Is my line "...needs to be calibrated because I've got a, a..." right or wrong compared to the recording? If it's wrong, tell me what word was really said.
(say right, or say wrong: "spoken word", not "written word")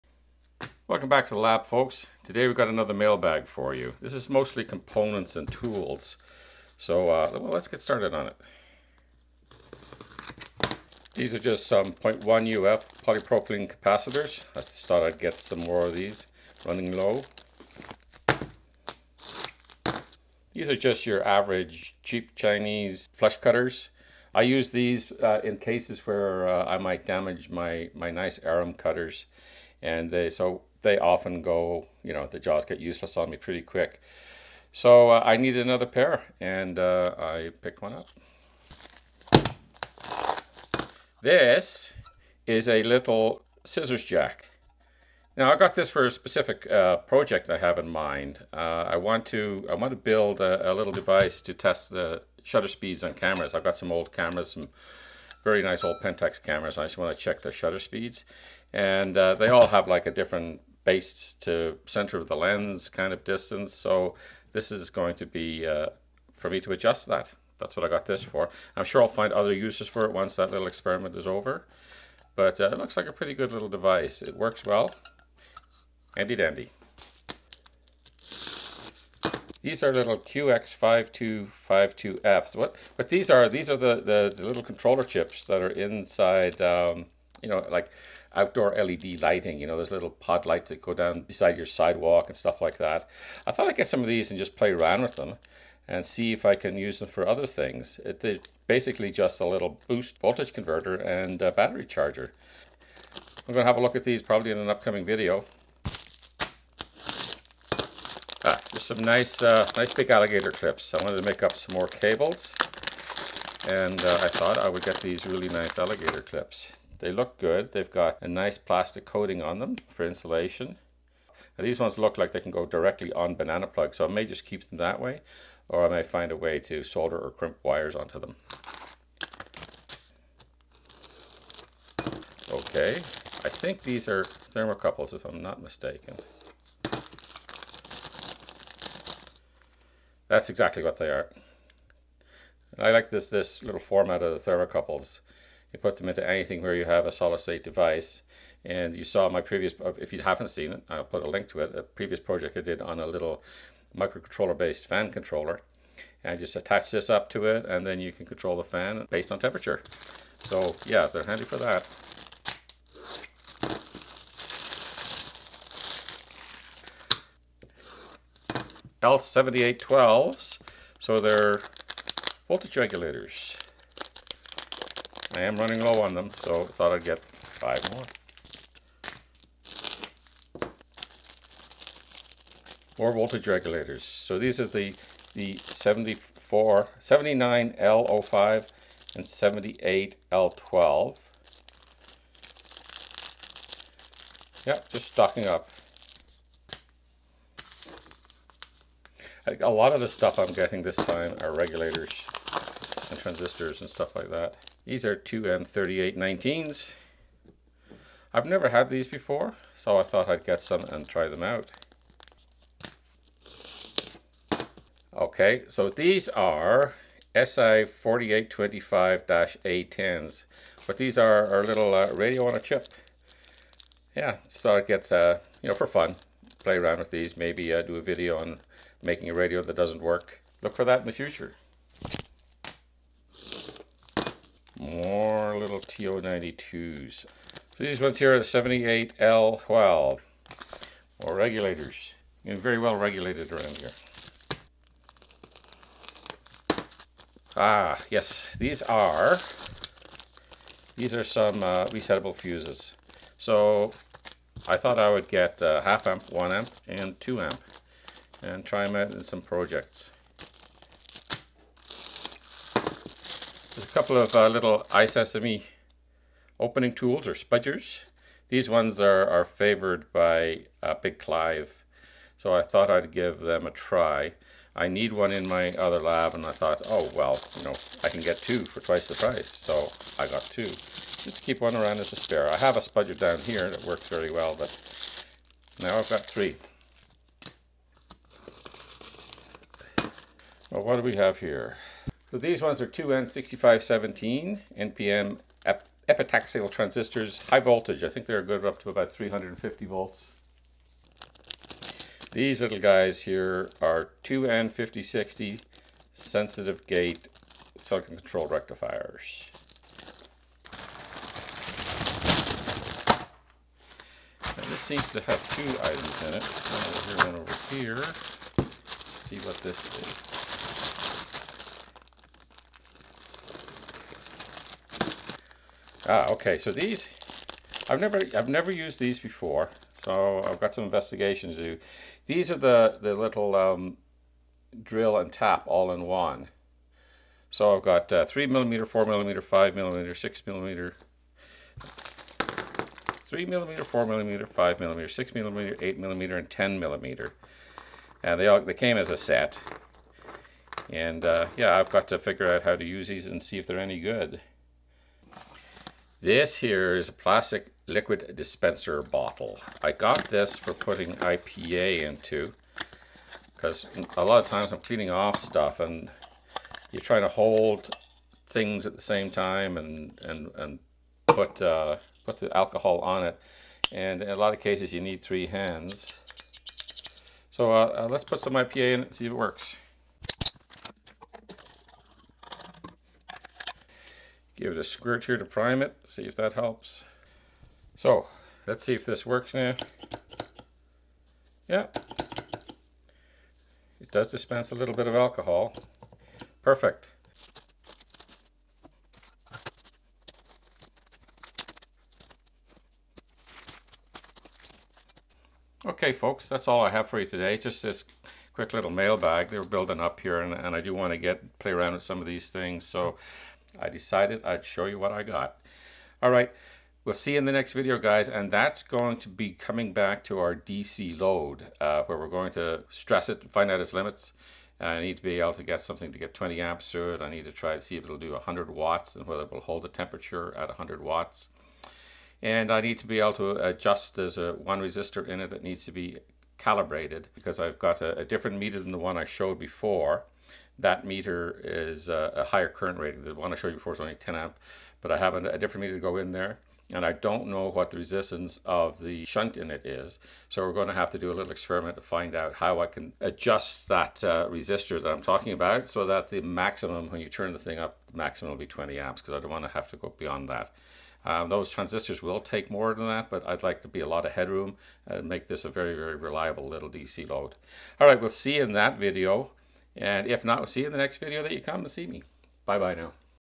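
right.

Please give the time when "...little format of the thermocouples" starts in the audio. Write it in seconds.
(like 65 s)
143 s.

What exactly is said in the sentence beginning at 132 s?
Okay, I think these are thermocouples if I'm not mistaken.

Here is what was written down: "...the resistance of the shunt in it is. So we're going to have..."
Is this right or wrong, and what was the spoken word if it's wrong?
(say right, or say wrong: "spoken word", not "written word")
right.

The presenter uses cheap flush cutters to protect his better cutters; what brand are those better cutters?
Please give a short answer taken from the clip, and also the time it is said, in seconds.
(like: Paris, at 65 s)
Xuron, at 28 s.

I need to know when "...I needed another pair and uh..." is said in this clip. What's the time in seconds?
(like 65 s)
35 s.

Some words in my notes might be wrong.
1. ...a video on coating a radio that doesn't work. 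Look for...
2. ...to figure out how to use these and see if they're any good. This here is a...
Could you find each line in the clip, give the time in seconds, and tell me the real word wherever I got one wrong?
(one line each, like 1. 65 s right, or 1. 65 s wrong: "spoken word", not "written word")
1. 227 s wrong: "making", not "coating"
2. 352 s right.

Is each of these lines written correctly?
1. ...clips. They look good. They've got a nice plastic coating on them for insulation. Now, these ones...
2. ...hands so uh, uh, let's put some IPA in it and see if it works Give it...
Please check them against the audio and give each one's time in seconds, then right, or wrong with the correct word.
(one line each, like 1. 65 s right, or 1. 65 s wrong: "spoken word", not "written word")
1. 116 s right
2. 375 s right.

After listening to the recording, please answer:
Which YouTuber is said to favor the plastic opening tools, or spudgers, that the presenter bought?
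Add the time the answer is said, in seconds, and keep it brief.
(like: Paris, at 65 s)
Big Clive, at 271 s.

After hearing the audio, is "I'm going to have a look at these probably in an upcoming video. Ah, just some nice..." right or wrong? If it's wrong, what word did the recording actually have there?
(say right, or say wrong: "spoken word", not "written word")
right.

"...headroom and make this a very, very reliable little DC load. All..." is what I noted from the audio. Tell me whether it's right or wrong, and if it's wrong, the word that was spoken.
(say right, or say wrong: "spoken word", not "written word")
right.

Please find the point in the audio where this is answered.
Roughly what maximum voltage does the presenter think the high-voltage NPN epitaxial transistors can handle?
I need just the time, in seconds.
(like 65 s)
299 s.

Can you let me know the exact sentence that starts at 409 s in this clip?
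They're building up here and, and I do want to get play around with some of these things.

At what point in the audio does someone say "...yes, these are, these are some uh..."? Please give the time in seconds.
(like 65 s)
248 s.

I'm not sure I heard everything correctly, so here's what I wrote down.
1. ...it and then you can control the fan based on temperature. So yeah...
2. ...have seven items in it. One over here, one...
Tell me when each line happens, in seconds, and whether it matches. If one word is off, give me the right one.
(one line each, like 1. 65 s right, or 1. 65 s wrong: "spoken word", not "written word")
1. 157 s right
2. 315 s wrong: "two", not "seven".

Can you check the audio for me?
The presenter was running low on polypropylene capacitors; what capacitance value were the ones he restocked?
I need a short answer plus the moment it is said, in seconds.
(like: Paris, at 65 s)
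0.1 uF, at 11 s.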